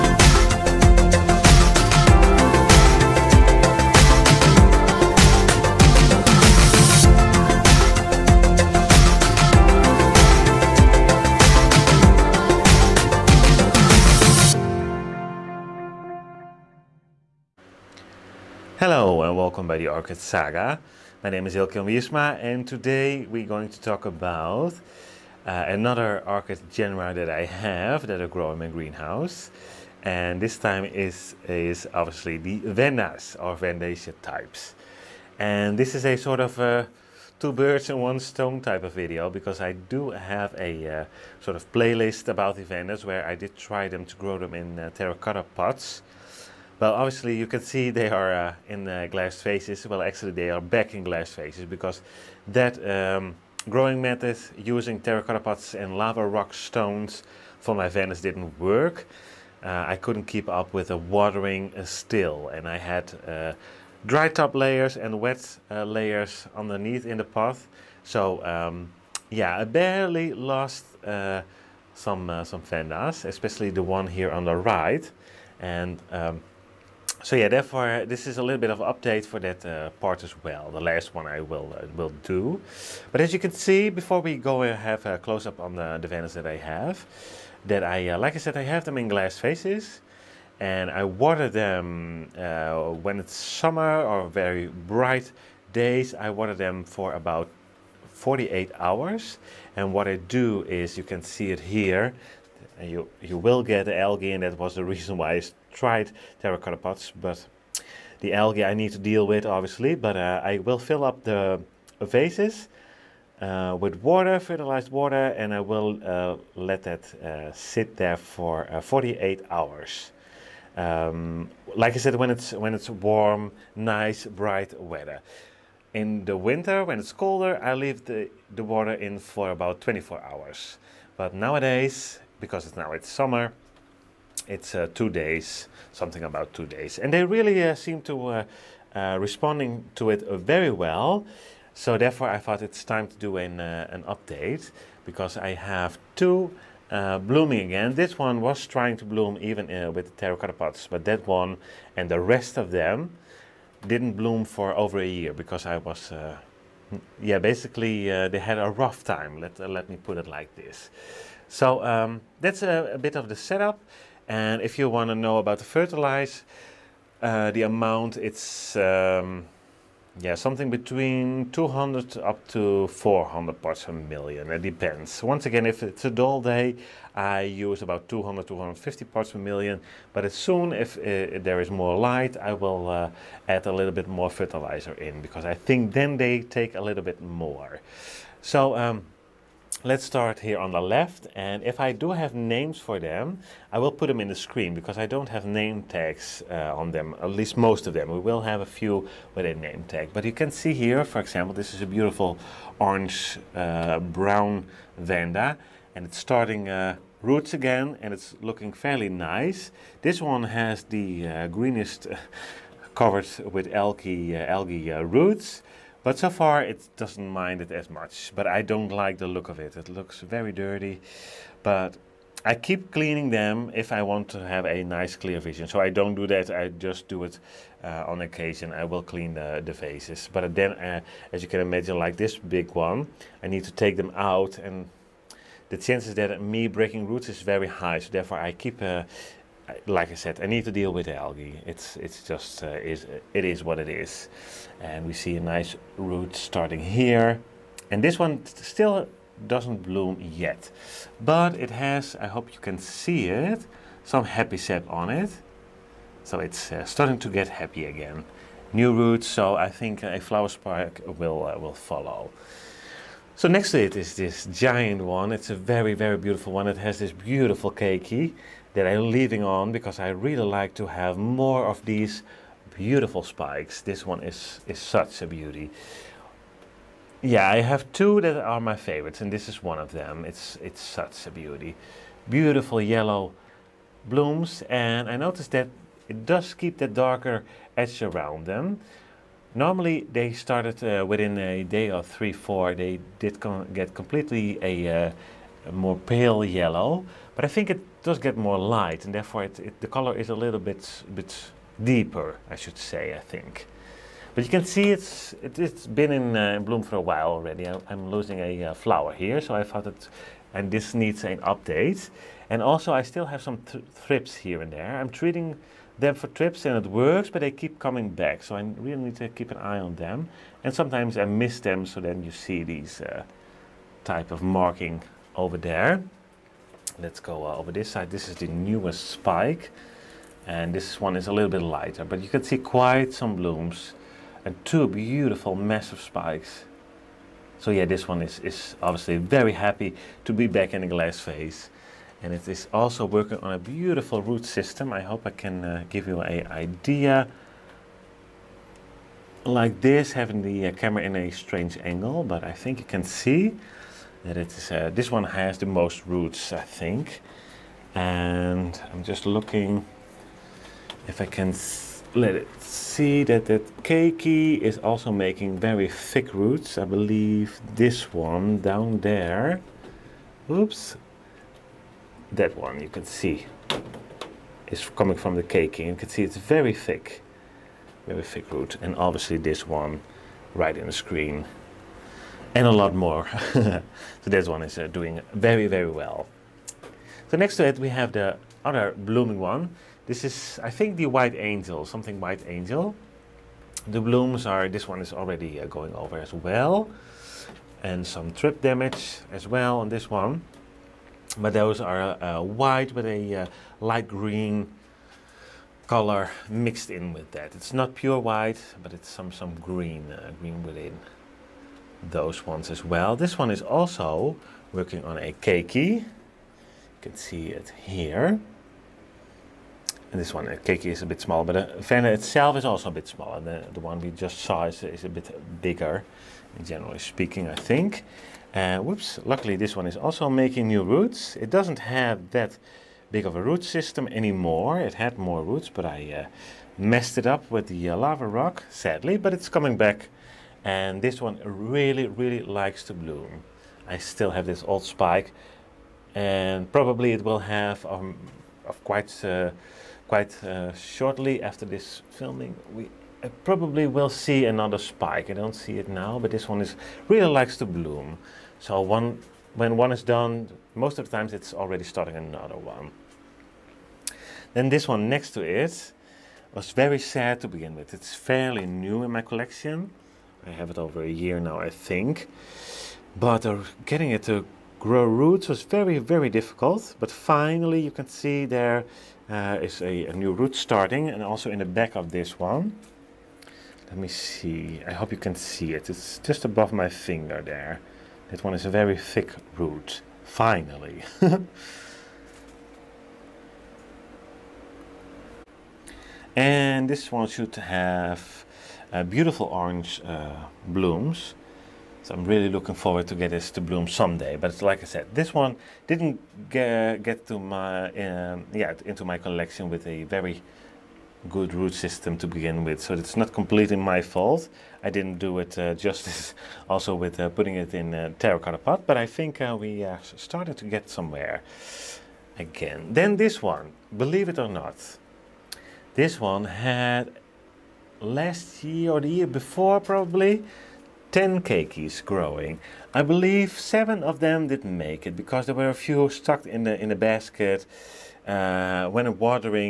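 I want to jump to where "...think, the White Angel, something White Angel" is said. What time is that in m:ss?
6:30.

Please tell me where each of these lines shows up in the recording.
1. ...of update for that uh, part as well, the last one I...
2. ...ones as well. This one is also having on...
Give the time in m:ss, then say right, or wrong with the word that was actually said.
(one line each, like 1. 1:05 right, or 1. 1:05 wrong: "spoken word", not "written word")
1. 1:18 right
2. 6:52 wrong: "working", not "having".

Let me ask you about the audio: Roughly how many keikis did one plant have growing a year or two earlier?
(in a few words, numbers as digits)
10.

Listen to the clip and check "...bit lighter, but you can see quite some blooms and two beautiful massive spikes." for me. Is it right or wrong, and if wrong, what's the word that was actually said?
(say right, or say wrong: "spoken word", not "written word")
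right.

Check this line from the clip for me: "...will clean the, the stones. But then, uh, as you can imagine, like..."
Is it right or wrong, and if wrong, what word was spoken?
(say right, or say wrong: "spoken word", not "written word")
wrong: "faces", not "stones".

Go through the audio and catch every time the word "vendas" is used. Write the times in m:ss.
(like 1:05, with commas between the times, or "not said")
1:12, 3:24.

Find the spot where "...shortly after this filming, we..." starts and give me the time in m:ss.
7:30.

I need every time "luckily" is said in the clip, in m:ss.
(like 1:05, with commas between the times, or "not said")
7:09.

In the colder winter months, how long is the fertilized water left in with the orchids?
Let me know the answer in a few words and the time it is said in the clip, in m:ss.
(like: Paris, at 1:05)
24 hours, at 2:09.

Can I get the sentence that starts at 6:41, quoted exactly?
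But those are uh, white with a uh, light green color mixed in with that.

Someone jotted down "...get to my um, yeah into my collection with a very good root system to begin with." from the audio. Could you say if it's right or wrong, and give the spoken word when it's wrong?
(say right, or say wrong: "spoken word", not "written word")
right.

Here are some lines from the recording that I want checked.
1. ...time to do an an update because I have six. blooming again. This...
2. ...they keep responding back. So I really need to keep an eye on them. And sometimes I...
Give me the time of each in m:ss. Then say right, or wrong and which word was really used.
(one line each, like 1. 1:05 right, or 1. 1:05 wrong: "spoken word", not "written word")
1. 2:22 wrong: "two", not "six"
2. 5:17 wrong: "coming", not "responding".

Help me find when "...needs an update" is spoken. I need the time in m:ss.
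5:10.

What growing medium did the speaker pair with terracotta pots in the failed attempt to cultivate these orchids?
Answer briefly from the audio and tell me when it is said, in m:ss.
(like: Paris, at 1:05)
Lava rock stones, at 0:55.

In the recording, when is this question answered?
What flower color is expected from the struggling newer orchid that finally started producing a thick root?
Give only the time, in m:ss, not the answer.
8:19.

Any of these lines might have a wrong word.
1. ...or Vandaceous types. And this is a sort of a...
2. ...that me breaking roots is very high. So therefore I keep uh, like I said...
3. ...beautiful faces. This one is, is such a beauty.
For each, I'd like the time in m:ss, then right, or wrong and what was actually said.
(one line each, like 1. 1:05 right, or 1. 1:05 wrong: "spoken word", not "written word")
1. 0:33 right
2. 3:56 right
3. 4:32 wrong: "spikes", not "faces".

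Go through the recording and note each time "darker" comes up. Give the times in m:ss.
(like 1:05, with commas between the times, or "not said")
4:46.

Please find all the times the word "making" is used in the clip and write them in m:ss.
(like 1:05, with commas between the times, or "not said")
6:05, 7:10.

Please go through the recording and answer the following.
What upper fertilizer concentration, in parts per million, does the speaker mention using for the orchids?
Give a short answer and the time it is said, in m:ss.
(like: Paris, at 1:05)
400, at 2:52.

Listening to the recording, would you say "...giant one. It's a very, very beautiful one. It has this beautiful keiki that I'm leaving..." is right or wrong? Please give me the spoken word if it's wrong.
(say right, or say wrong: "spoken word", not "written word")
right.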